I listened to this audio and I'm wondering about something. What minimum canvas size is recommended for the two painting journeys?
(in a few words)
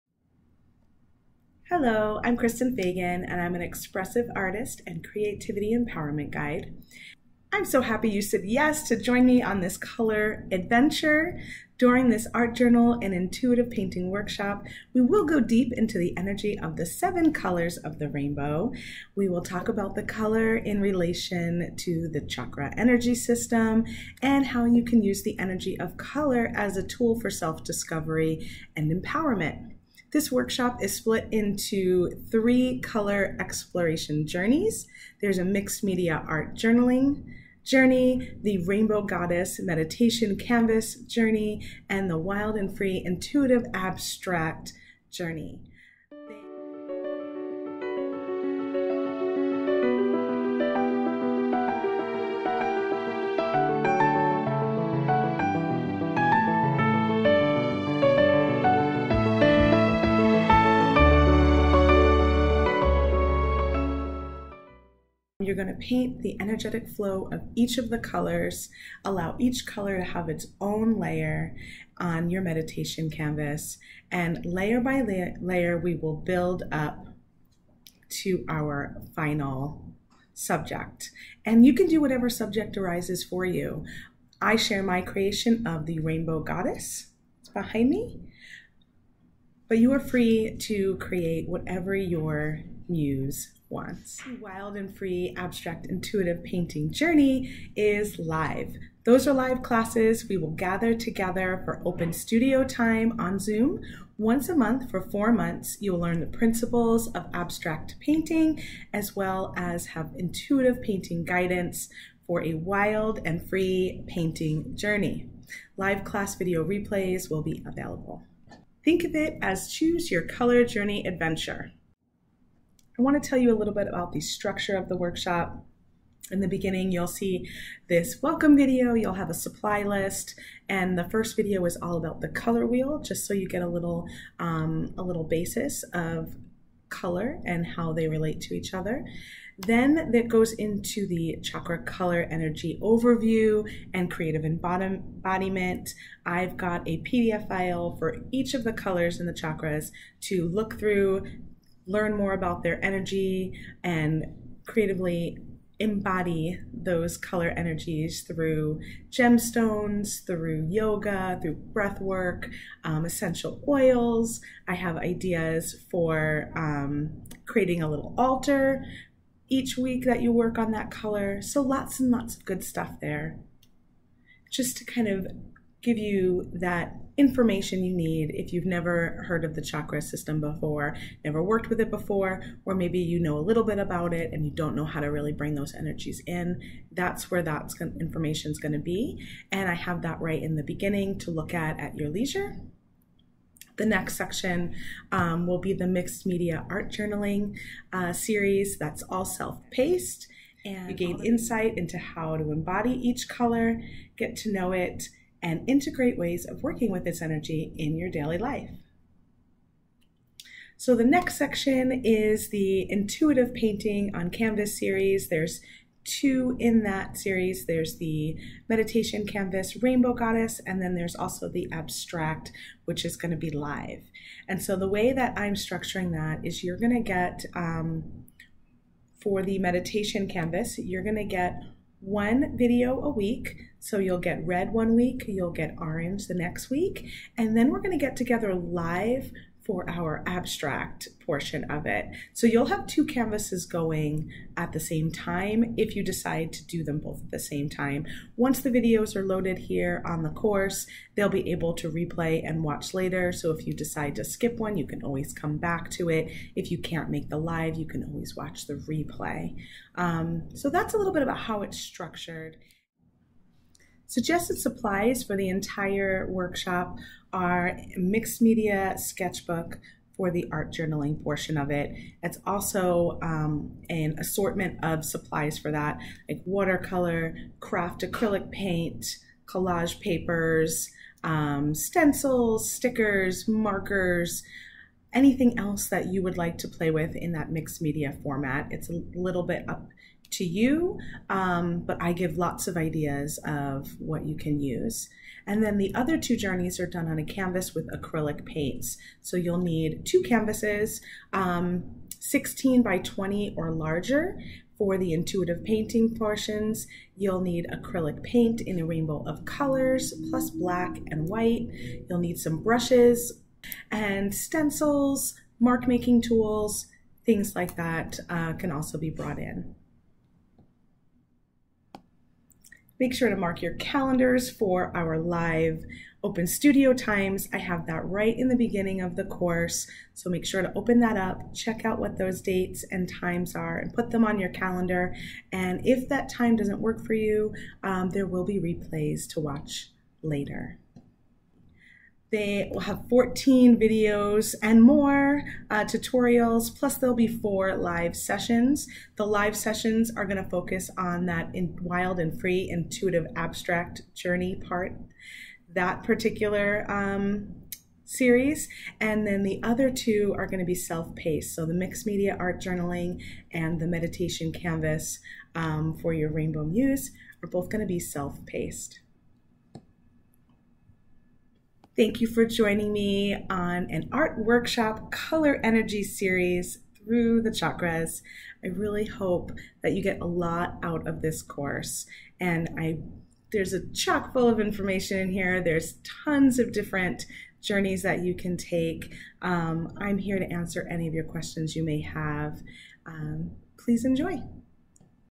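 16 by 20.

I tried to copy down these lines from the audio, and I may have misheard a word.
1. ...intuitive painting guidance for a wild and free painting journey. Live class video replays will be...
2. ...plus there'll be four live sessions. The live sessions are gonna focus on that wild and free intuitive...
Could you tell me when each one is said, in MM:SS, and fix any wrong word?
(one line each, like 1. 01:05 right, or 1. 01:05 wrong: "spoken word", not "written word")
1. 01:50 right
2. 05:46 right.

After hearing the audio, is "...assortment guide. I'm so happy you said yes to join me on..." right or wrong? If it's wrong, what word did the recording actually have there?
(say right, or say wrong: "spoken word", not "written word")
wrong: "empowerment", not "assortment".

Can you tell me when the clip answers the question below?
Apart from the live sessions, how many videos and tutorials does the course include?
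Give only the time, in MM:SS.
05:43.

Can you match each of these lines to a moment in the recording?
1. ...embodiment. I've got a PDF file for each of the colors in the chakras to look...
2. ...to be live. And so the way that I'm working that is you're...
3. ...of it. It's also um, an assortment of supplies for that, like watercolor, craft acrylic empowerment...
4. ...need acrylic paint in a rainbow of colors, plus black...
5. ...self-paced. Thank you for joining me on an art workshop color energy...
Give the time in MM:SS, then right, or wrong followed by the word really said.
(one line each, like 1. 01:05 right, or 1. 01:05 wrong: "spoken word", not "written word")
1. 02:24 right
2. 03:43 wrong: "structuring", not "working"
3. 04:31 wrong: "paint", not "empowerment"
4. 05:07 right
5. 06:07 right.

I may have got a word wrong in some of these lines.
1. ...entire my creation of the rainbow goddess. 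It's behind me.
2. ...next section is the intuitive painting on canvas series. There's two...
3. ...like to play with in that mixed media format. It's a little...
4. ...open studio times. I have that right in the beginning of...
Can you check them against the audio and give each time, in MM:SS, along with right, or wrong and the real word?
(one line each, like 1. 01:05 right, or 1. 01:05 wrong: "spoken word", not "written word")
1. 01:24 wrong: "share", not "entire"
2. 03:31 right
3. 04:46 right
4. 05:26 right.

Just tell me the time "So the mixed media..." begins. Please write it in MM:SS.
06:01.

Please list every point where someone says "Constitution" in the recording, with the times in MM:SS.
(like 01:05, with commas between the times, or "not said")
not said.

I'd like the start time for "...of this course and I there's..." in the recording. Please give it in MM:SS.
06:21.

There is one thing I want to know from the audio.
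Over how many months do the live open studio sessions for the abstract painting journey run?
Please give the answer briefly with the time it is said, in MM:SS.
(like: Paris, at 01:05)
4, at 01:45.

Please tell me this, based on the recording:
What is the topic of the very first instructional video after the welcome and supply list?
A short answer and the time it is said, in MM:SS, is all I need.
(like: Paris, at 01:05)
The color wheel, at 02:12.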